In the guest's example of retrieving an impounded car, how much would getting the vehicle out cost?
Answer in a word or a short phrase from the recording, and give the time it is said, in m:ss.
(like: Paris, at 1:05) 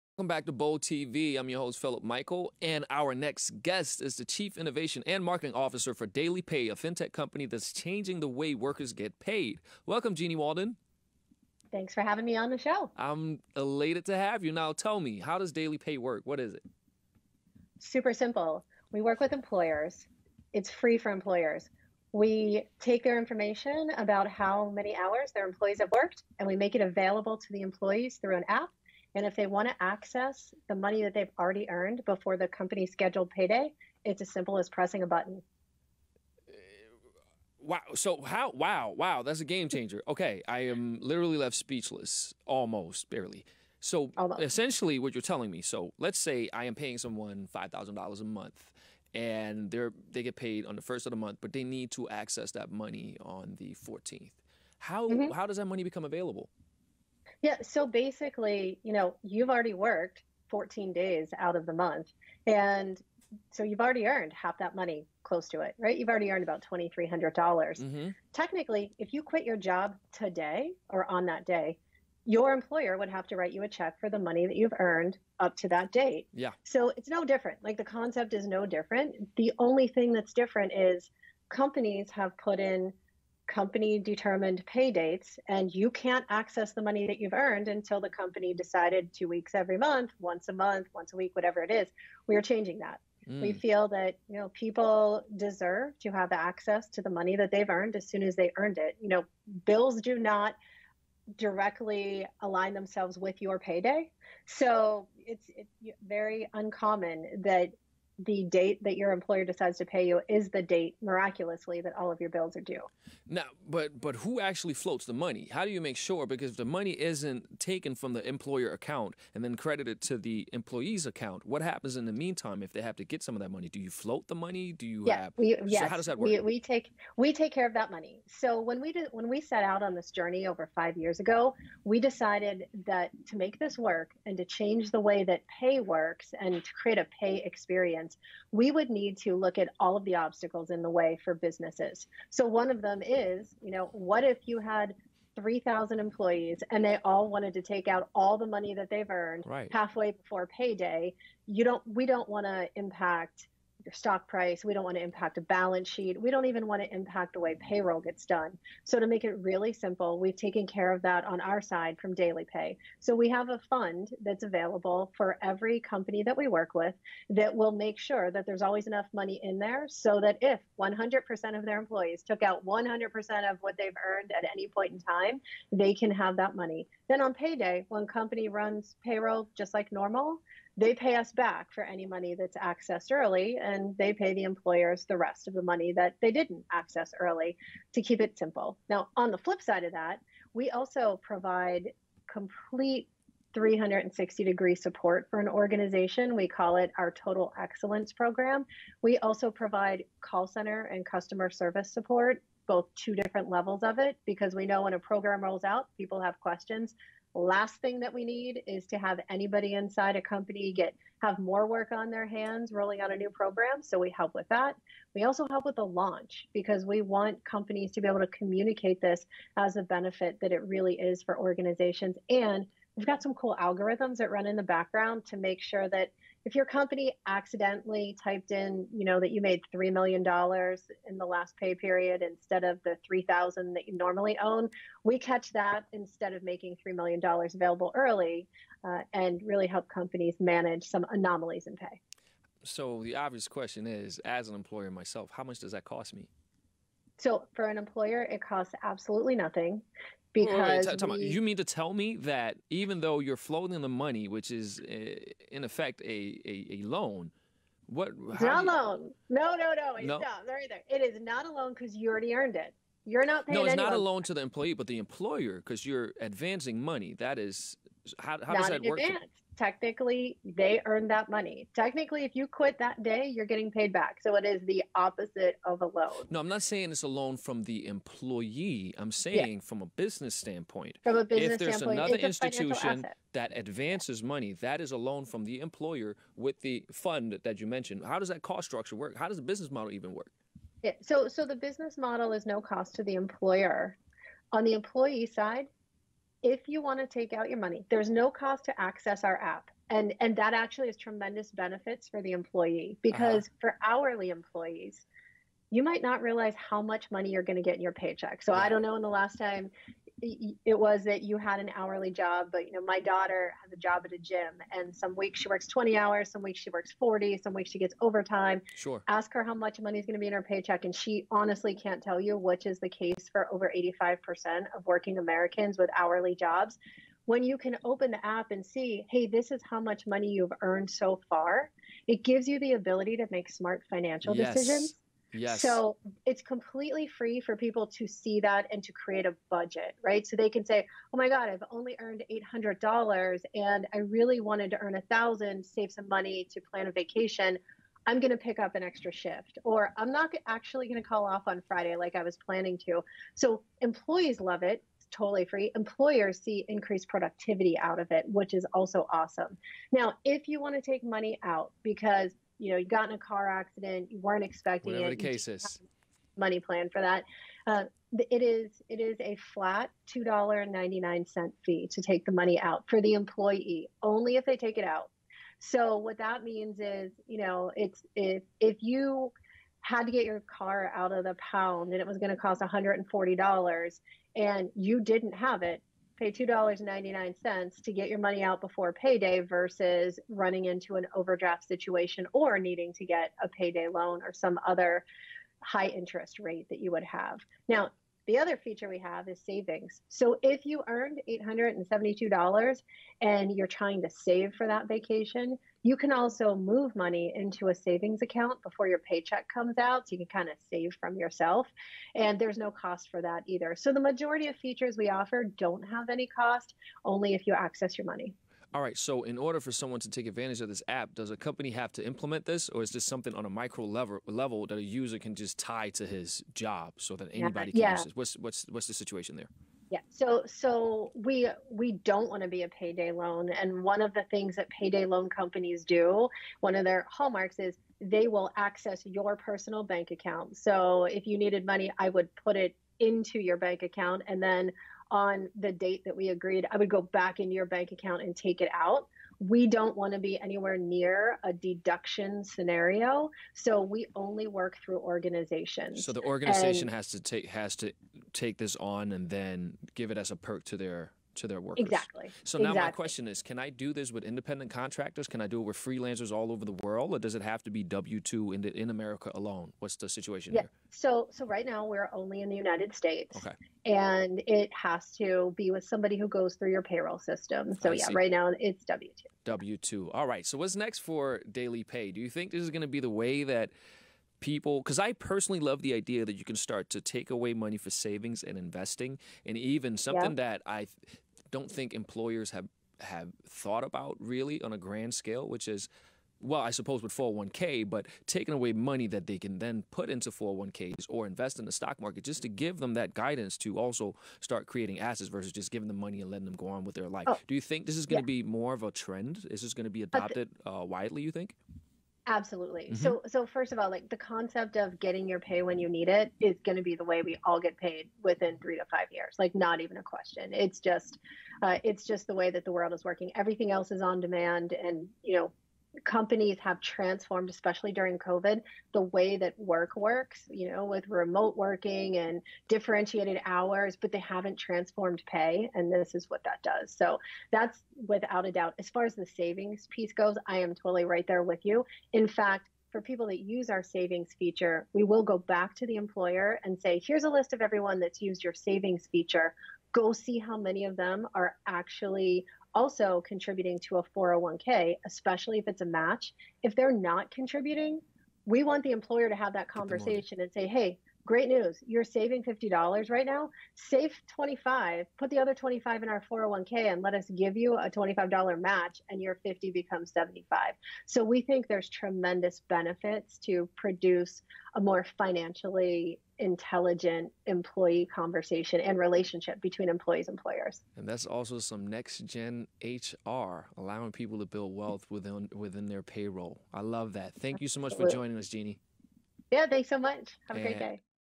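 $140, at 6:22.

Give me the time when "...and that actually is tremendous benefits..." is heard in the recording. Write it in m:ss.
5:00.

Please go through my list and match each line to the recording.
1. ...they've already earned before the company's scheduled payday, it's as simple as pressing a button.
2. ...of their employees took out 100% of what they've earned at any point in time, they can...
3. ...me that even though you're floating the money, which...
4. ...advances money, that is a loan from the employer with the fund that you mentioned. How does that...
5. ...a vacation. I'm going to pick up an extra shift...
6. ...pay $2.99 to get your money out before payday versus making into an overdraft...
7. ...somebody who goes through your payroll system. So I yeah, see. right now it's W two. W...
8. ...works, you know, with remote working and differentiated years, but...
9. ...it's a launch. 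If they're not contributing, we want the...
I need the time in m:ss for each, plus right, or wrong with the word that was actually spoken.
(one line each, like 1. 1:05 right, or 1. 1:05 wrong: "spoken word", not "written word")
1. 0:31 right
2. 2:51 right
3. 4:11 right
4. 4:43 right
5. 5:46 right
6. 6:26 wrong: "running", not "making"
7. 7:55 right
8. 8:49 wrong: "hours", not "years"
9. 9:15 wrong: "match", not "launch".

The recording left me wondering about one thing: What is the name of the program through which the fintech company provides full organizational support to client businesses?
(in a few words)
Total Excellence Program.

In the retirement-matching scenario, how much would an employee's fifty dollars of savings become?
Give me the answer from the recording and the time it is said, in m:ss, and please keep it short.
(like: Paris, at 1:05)
75, at 9:30.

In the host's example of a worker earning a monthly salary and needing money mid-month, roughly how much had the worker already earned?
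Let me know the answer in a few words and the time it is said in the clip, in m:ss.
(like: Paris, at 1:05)
$2,300, at 1:06.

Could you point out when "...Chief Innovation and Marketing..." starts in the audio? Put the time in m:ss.
0:04.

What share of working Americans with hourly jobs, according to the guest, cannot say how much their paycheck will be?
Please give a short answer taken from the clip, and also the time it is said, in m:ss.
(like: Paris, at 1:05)
over 85%, at 5:23.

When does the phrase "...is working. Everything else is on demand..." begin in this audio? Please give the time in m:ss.
8:42.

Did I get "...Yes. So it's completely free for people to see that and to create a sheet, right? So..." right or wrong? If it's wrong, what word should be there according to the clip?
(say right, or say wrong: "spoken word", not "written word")
wrong: "budget", not "sheet".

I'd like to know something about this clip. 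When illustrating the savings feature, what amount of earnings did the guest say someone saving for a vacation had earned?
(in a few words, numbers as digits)
$872.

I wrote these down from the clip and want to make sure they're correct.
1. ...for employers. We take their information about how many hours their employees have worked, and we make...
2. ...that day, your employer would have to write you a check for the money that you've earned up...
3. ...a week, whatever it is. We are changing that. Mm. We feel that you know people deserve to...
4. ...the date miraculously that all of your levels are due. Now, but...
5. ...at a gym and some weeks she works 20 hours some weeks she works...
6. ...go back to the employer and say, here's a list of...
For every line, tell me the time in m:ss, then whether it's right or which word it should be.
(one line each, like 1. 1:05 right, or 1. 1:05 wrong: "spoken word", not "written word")
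1. 0:20 right
2. 1:11 right
3. 1:31 right
4. 1:50 wrong: "bills", not "levels"
5. 5:14 right
6. 9:05 right.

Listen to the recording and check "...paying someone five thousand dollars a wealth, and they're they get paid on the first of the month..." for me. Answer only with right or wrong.
wrong.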